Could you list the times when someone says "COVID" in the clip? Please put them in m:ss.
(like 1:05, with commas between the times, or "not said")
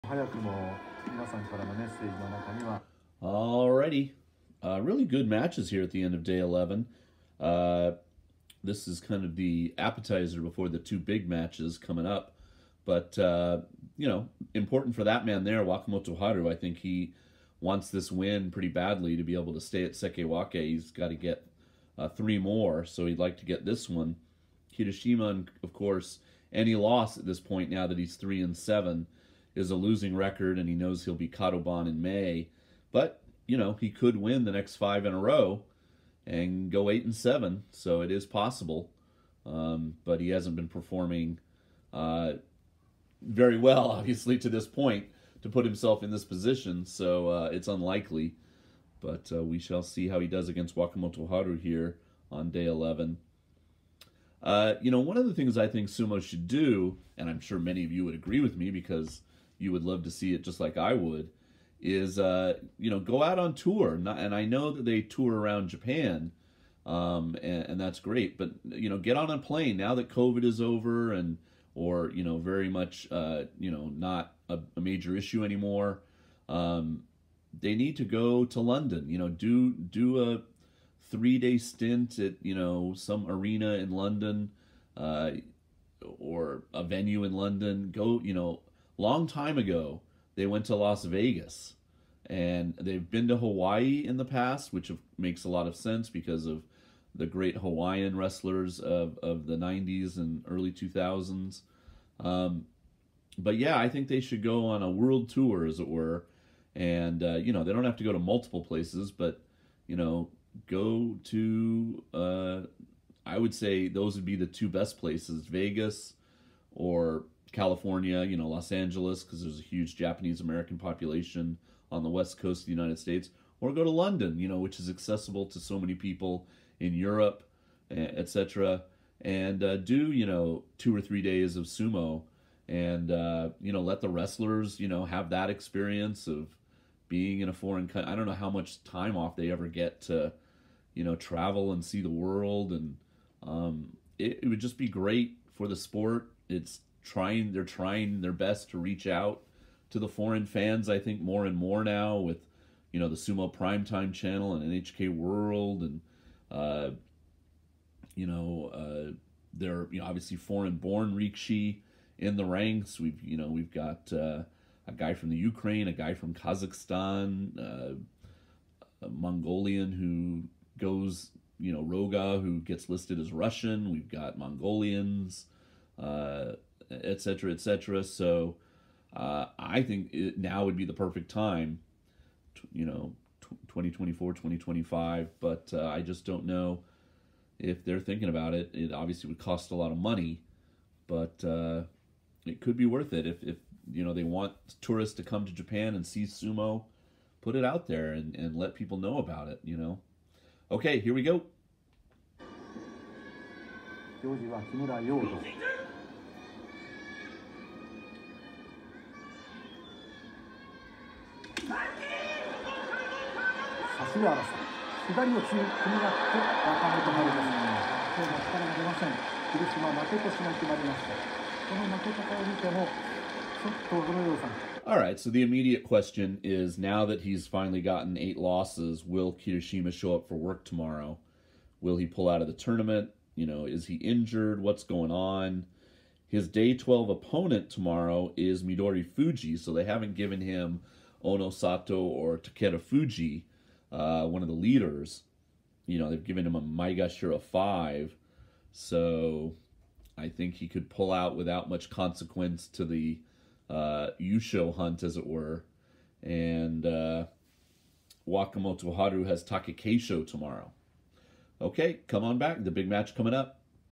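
1:10.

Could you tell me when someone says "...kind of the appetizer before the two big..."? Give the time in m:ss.
0:08.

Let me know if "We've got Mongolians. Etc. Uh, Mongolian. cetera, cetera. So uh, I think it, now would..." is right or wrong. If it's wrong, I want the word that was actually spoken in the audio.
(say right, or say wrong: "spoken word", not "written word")
wrong: "Etc", not "Mongolian".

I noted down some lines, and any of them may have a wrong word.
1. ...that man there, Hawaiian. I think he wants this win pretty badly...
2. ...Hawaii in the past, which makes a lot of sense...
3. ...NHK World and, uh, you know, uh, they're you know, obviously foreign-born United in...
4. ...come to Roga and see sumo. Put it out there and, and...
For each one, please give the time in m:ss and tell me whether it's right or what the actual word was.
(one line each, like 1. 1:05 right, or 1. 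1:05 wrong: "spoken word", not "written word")
1. 0:15 wrong: "Wakamotoharu", not "Hawaiian"
2. 1:33 right
3. 2:34 wrong: "Rikishi", not "United"
4. 3:15 wrong: "Japan", not "Roga".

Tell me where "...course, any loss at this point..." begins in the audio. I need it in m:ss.
0:25.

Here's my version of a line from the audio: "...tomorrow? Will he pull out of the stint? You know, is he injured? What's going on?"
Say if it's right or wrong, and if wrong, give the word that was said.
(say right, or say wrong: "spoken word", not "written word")
wrong: "tournament", not "stint".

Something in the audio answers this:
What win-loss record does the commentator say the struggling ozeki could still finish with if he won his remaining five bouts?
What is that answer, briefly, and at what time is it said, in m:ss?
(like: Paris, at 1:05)
8-7, at 0:36.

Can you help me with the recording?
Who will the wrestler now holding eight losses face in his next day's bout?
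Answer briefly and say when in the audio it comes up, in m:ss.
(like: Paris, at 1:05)
Midorifuji, at 3:58.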